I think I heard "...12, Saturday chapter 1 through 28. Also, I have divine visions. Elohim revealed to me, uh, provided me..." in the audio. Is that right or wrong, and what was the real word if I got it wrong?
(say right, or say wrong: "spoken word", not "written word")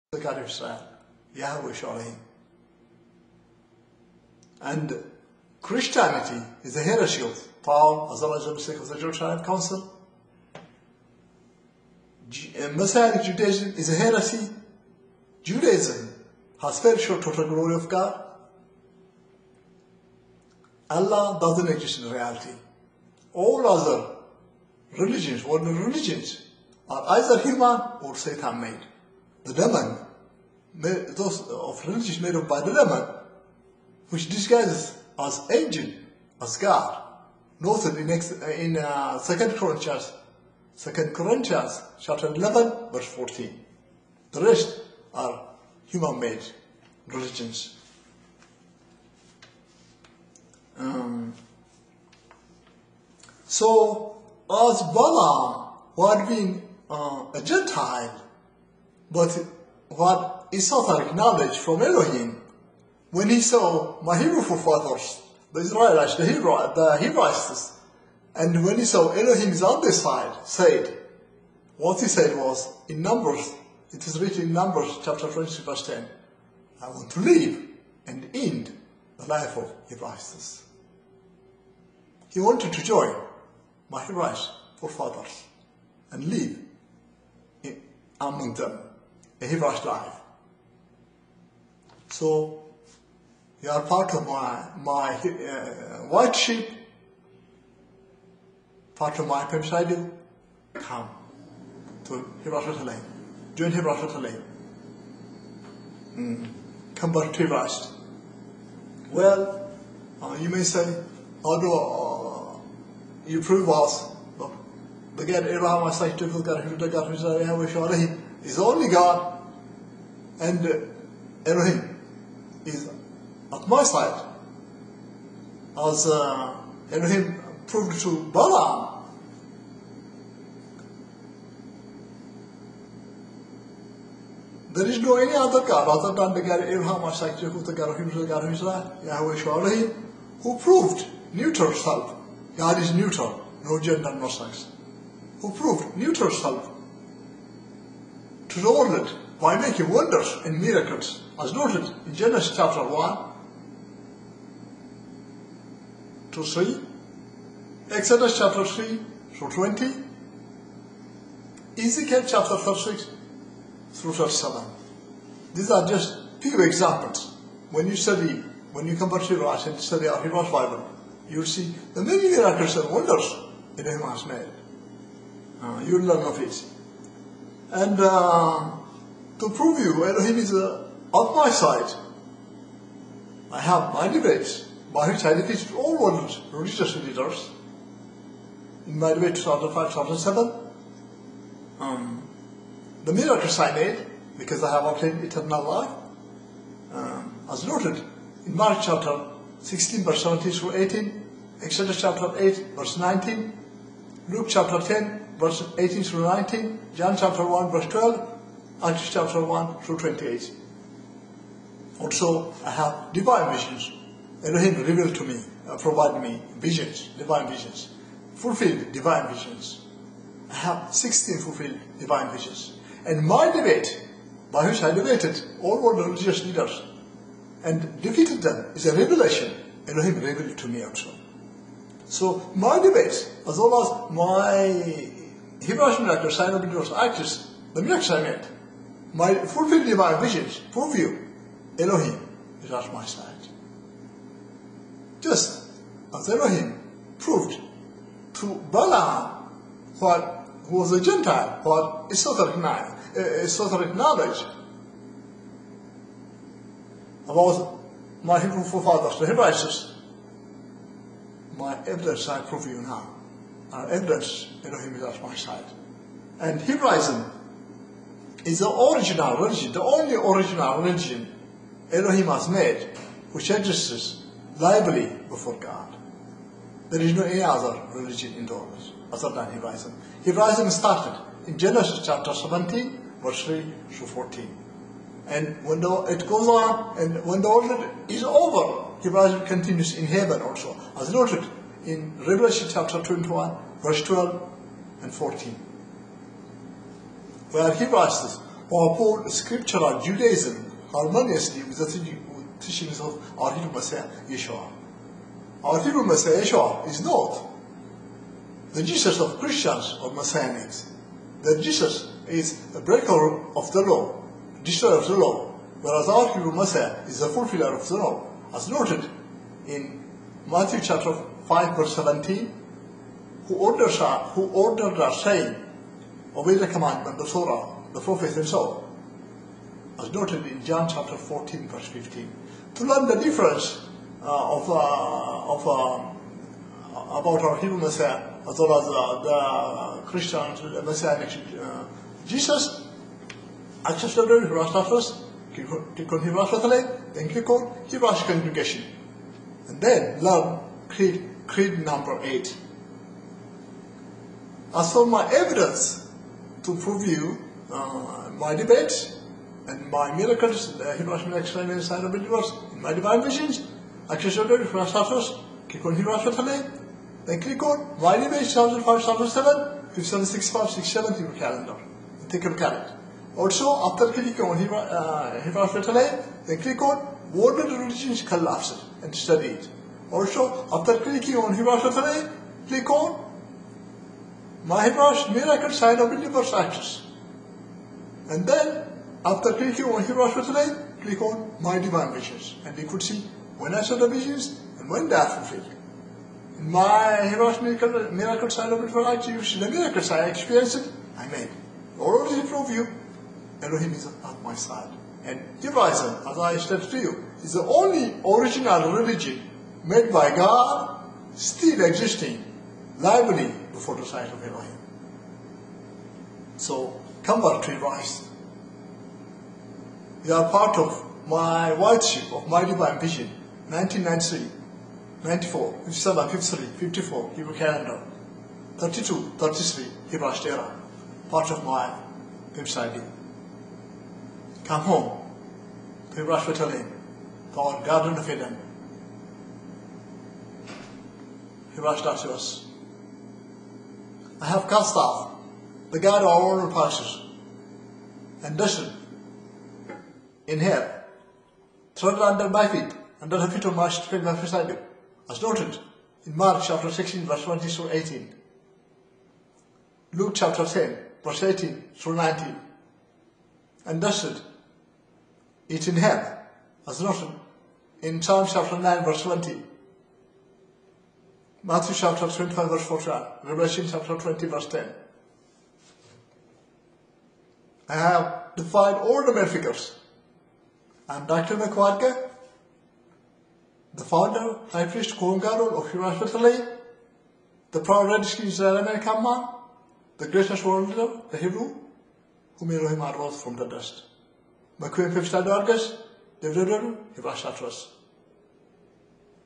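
wrong: "Acts", not "Saturday".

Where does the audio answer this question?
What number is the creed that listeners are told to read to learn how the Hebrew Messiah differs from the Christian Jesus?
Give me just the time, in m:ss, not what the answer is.
5:51.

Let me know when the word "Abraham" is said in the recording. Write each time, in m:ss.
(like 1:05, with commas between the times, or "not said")
2:16, 2:53.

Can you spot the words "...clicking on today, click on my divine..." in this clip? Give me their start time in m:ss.
6:29.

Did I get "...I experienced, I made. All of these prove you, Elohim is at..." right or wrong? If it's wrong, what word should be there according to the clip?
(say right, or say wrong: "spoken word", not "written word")
right.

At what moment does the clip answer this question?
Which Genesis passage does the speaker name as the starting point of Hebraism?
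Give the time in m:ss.
4:41.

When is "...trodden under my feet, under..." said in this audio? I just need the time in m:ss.
7:31.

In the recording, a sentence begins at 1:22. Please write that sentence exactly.
He wanted to join my Hebrewites forefathers and live among them.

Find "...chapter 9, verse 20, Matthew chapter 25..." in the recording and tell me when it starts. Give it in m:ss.
7:48.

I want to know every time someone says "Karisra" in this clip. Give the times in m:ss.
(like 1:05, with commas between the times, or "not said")
0:00.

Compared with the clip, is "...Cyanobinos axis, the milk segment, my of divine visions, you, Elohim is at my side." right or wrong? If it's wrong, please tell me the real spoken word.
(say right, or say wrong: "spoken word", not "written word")
right.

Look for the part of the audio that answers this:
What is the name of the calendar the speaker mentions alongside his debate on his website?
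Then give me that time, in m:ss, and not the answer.
6:12.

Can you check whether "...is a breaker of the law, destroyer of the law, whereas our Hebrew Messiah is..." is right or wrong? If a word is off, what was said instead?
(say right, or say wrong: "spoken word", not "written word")
right.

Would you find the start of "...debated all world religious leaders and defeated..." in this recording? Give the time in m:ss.
3:44.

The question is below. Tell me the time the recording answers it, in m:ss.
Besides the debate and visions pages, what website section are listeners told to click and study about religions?
6:17.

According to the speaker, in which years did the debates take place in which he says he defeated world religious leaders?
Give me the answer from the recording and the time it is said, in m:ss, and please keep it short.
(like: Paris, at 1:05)
2005 2007, at 3:09.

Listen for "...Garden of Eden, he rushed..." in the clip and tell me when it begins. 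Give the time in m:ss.
7:17.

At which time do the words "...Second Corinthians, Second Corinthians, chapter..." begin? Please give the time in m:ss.
0:39.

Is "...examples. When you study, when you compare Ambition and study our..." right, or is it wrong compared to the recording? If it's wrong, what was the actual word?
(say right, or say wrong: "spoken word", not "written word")
wrong: "Shiraz", not "Ambition".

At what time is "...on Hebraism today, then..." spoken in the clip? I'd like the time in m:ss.
6:05.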